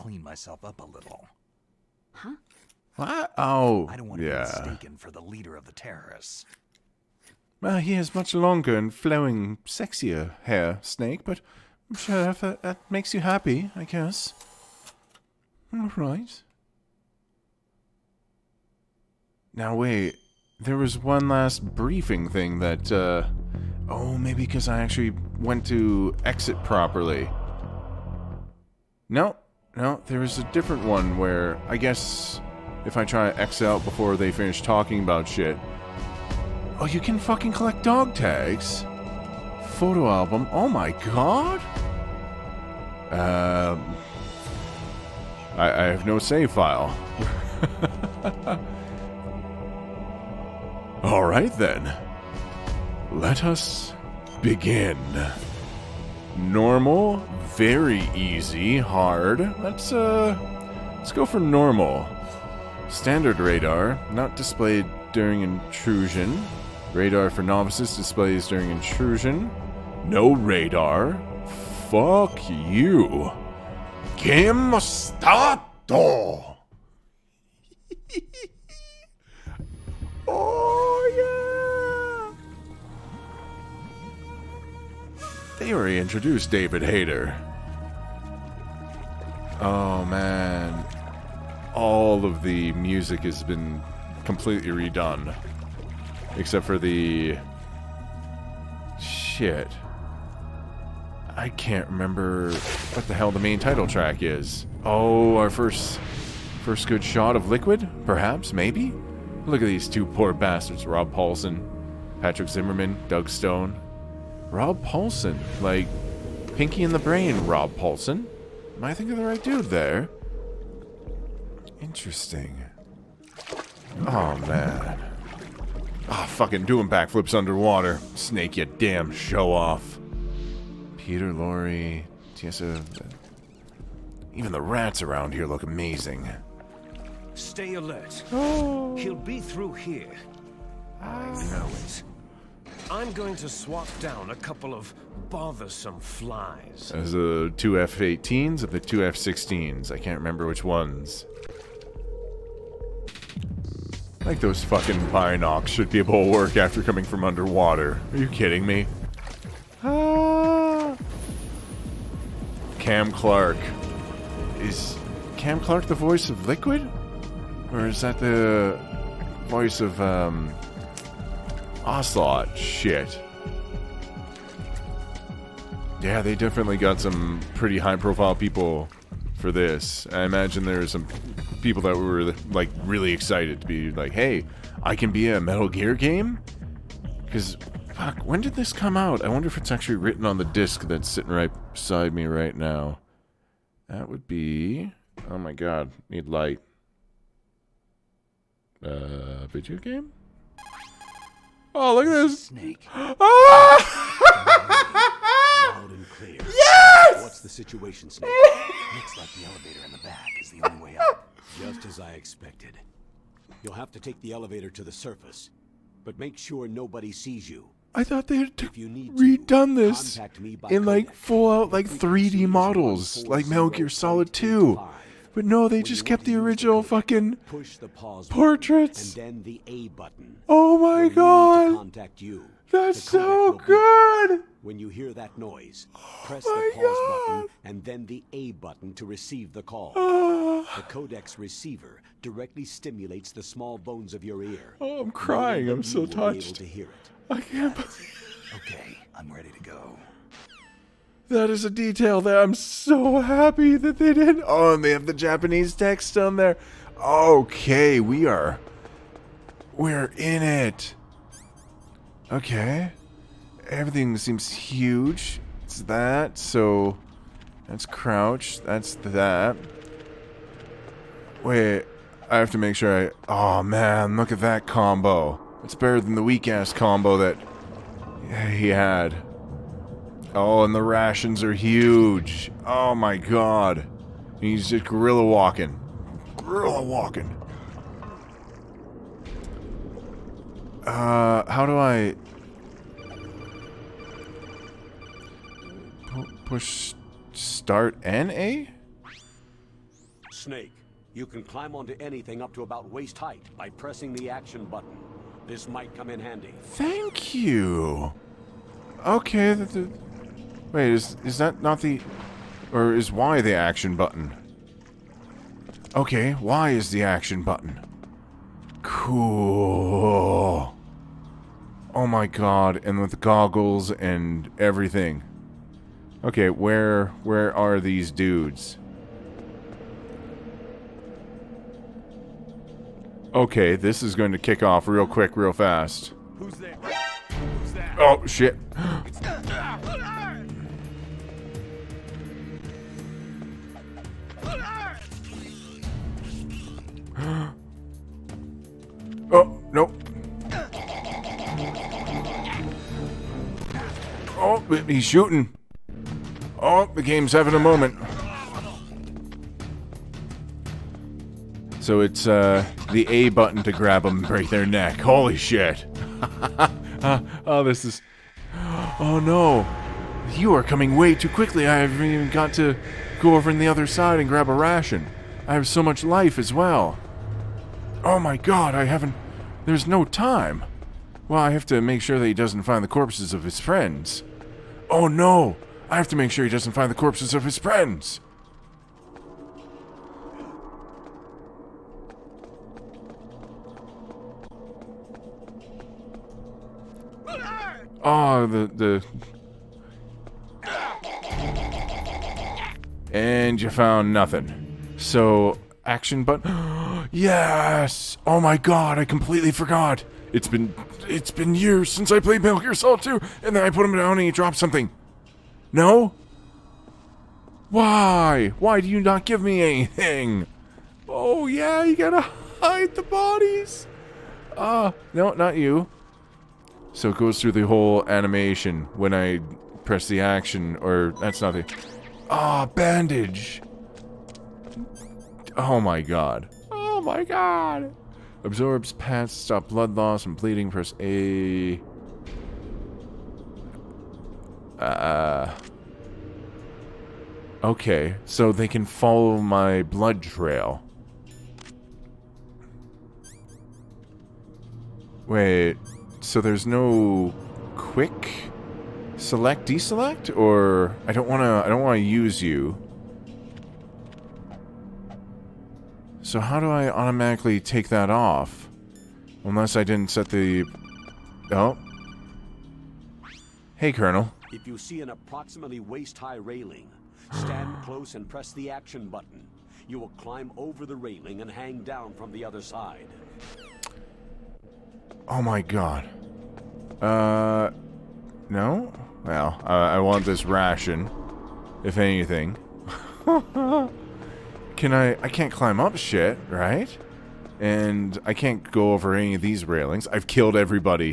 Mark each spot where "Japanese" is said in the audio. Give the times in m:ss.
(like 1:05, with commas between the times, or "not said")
4:15.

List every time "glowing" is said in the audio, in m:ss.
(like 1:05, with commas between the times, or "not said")
not said.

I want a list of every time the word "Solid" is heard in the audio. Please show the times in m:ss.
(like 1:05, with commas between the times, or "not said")
3:43, 6:52.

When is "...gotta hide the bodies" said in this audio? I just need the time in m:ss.
7:01.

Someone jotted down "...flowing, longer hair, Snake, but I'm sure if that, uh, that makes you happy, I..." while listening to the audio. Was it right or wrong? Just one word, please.
wrong.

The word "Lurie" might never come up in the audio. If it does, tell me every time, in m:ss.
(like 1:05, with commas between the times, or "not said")
2:11.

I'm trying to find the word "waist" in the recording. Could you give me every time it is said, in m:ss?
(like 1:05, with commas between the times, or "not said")
5:02, 7:55.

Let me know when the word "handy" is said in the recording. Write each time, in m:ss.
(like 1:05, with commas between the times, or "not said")
5:06.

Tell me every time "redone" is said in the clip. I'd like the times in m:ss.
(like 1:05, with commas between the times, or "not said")
1:34, 3:38.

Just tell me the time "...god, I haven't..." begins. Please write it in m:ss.
6:18.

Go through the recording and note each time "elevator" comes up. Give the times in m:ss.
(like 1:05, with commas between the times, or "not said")
3:29, 3:34.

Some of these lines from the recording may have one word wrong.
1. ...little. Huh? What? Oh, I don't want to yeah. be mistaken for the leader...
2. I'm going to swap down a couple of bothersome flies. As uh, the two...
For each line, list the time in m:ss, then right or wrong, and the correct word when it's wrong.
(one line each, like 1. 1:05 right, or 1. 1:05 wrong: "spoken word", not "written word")
1. 0:00 right
2. 2:22 right.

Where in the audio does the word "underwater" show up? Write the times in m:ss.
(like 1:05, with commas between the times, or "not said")
2:07, 2:37.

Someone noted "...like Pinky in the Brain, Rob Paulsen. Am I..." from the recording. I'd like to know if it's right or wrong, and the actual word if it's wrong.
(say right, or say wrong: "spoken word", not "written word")
right.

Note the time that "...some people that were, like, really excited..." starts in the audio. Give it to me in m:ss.
3:00.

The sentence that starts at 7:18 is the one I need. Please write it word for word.
Absorbs pads stop blood loss and bleeding.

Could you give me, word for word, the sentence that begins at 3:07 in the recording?
Because, fuck, when did this come out?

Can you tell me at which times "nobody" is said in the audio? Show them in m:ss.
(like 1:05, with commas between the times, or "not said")
3:36.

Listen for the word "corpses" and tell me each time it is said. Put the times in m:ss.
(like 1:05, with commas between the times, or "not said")
6:22, 6:26.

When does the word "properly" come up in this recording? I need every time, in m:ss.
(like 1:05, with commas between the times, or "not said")
0:26.